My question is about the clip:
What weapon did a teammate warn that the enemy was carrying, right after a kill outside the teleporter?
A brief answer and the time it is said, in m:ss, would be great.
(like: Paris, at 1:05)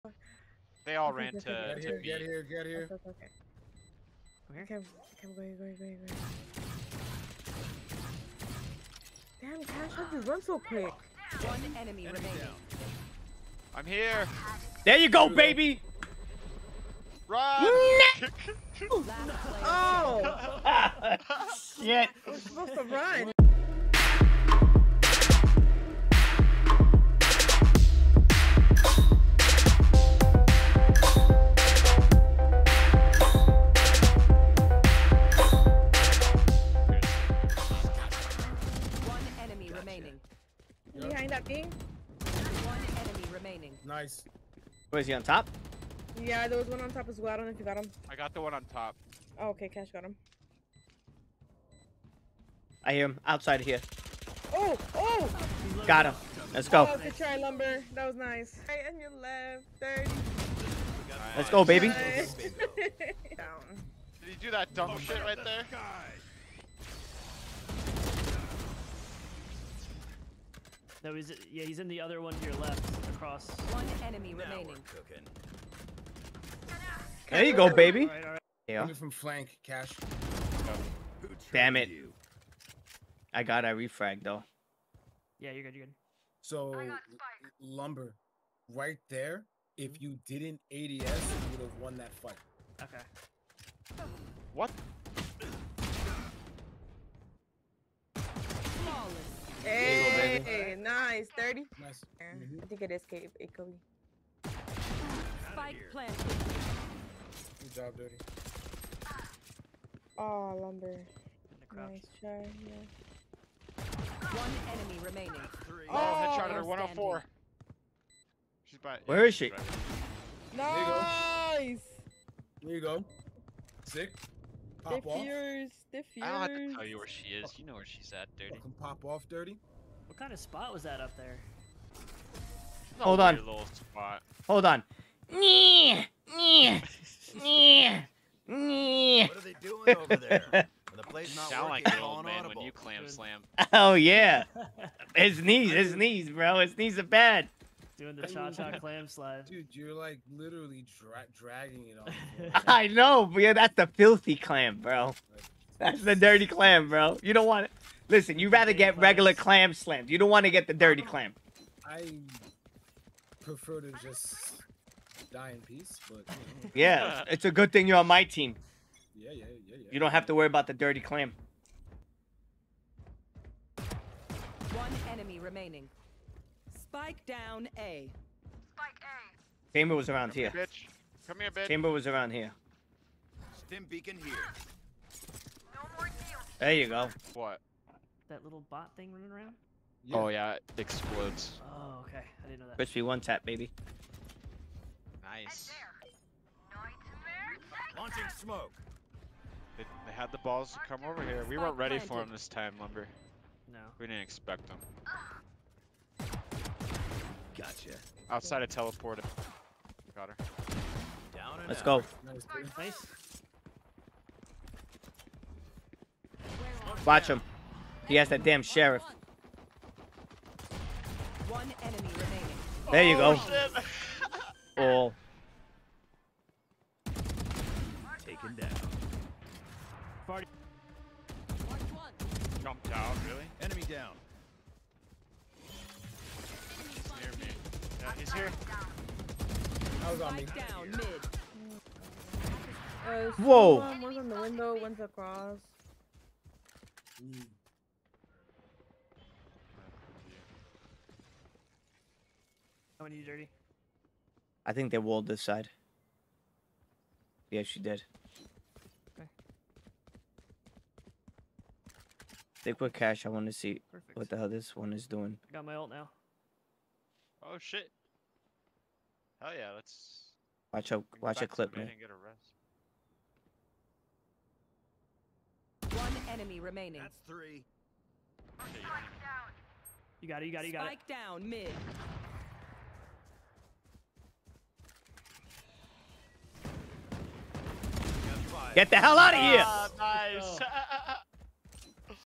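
sheriff, at 3:38.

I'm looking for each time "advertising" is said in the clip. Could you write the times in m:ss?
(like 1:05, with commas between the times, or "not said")
not said.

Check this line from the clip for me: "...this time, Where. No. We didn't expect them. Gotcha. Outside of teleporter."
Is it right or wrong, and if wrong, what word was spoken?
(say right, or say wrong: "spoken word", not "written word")
wrong: "Lumber", not "Where".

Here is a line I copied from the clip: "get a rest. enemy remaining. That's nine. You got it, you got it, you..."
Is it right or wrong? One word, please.
wrong.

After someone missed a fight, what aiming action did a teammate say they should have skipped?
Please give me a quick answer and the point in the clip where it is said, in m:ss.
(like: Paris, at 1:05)
ADS, at 1:30.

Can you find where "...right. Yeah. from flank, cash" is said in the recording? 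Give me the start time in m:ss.
1:18.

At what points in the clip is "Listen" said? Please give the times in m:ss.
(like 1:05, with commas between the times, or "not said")
2:38.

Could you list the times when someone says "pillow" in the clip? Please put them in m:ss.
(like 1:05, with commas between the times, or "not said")
not said.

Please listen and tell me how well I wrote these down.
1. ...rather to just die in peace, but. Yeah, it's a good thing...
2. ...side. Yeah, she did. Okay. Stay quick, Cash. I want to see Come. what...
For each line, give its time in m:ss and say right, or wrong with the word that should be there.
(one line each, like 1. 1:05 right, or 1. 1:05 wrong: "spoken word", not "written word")
1. 2:43 wrong: "prefer", not "rather"
2. 4:15 wrong: "Perfect", not "Come".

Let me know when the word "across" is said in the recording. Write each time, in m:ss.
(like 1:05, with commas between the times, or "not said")
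1:13, 4:04.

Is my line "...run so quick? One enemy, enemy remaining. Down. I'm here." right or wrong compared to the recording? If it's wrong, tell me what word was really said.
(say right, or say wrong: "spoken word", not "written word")
right.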